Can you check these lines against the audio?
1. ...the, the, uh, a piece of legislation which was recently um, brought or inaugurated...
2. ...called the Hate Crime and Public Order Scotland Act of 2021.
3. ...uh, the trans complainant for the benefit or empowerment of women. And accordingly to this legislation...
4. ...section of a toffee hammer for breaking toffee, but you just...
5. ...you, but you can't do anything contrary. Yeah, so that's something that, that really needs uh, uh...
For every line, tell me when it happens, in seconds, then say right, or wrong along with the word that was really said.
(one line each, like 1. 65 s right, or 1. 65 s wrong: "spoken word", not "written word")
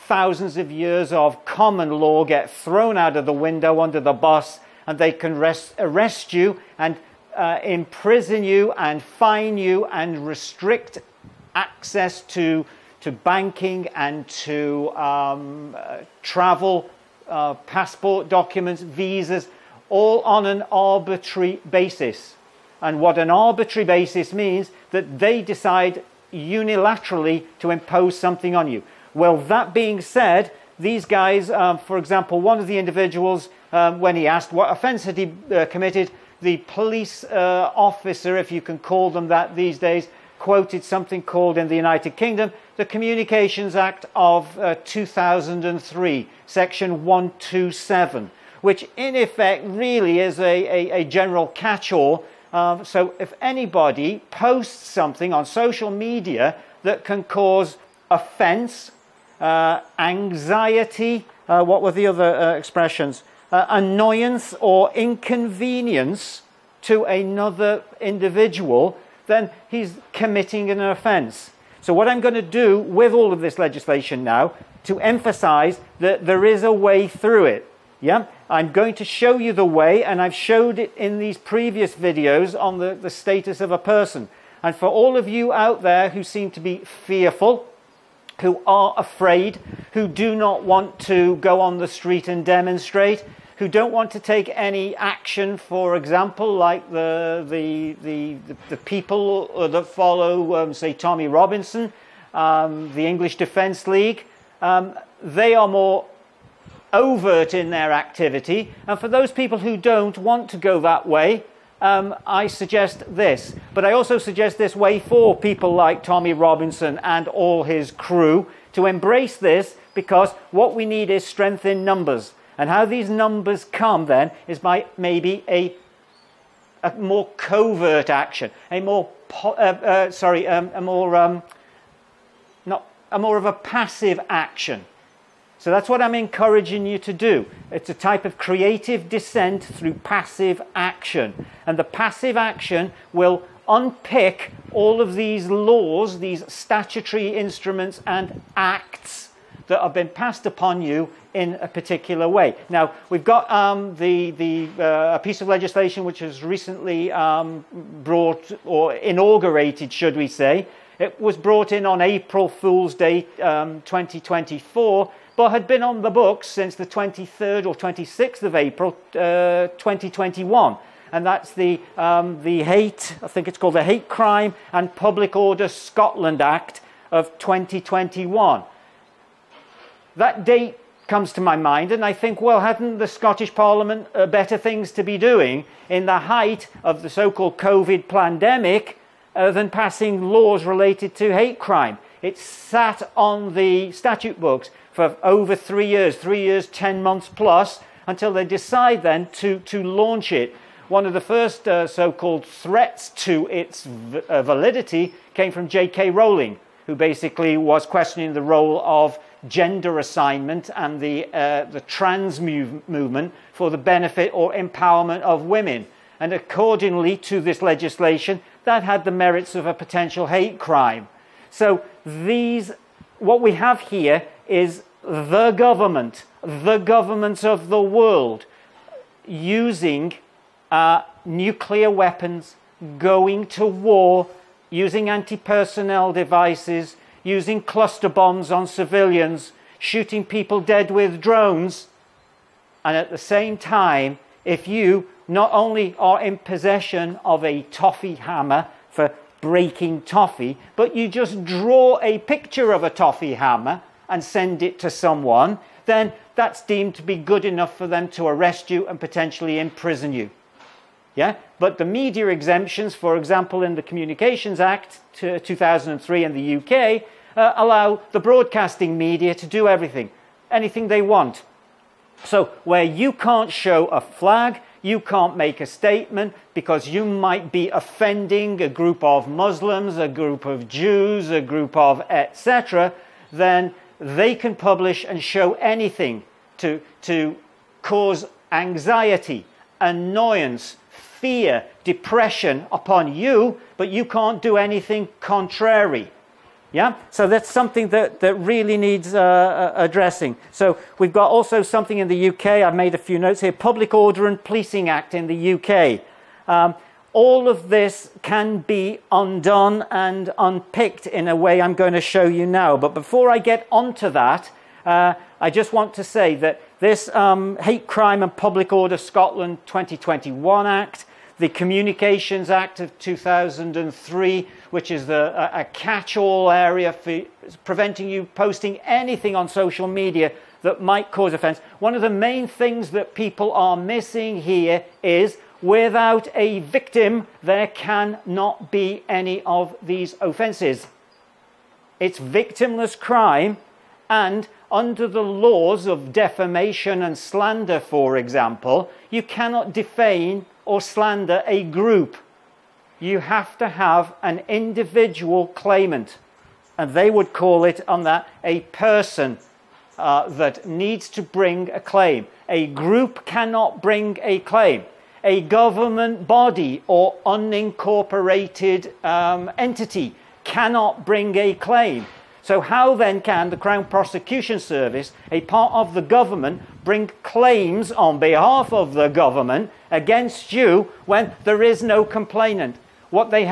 1. 153 s right
2. 173 s right
3. 211 s wrong: "movement", not "complainant"
4. 246 s wrong: "possession", not "section"
5. 293 s right.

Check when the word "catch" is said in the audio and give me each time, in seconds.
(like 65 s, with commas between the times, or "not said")
51 s, 325 s.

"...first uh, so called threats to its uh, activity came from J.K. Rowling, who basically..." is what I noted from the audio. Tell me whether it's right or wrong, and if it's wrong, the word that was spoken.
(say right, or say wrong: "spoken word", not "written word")
wrong: "validity", not "activity".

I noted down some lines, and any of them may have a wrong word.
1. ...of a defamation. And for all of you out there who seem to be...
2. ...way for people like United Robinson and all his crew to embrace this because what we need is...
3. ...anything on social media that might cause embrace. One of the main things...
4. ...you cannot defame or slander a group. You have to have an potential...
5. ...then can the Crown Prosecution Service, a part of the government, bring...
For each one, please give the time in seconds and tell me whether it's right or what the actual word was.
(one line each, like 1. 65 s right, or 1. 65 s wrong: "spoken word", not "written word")
1. 83 s wrong: "person", not "defamation"
2. 114 s wrong: "Tommy", not "United"
3. 328 s wrong: "offence", not "embrace"
4. 349 s wrong: "individual", not "potential"
5. 372 s right.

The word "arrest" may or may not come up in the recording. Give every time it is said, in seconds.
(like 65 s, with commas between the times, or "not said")
5 s, 258 s.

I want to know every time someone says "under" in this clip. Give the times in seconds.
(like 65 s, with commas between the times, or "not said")
3 s, 344 s.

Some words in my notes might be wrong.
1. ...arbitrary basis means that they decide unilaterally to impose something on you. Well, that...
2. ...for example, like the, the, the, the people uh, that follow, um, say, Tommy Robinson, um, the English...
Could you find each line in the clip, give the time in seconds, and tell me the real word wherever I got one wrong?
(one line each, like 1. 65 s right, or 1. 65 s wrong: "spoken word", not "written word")
1. 23 s right
2. 95 s right.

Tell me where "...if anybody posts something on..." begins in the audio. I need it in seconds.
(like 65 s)
53 s.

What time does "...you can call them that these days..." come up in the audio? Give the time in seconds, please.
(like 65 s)
38 s.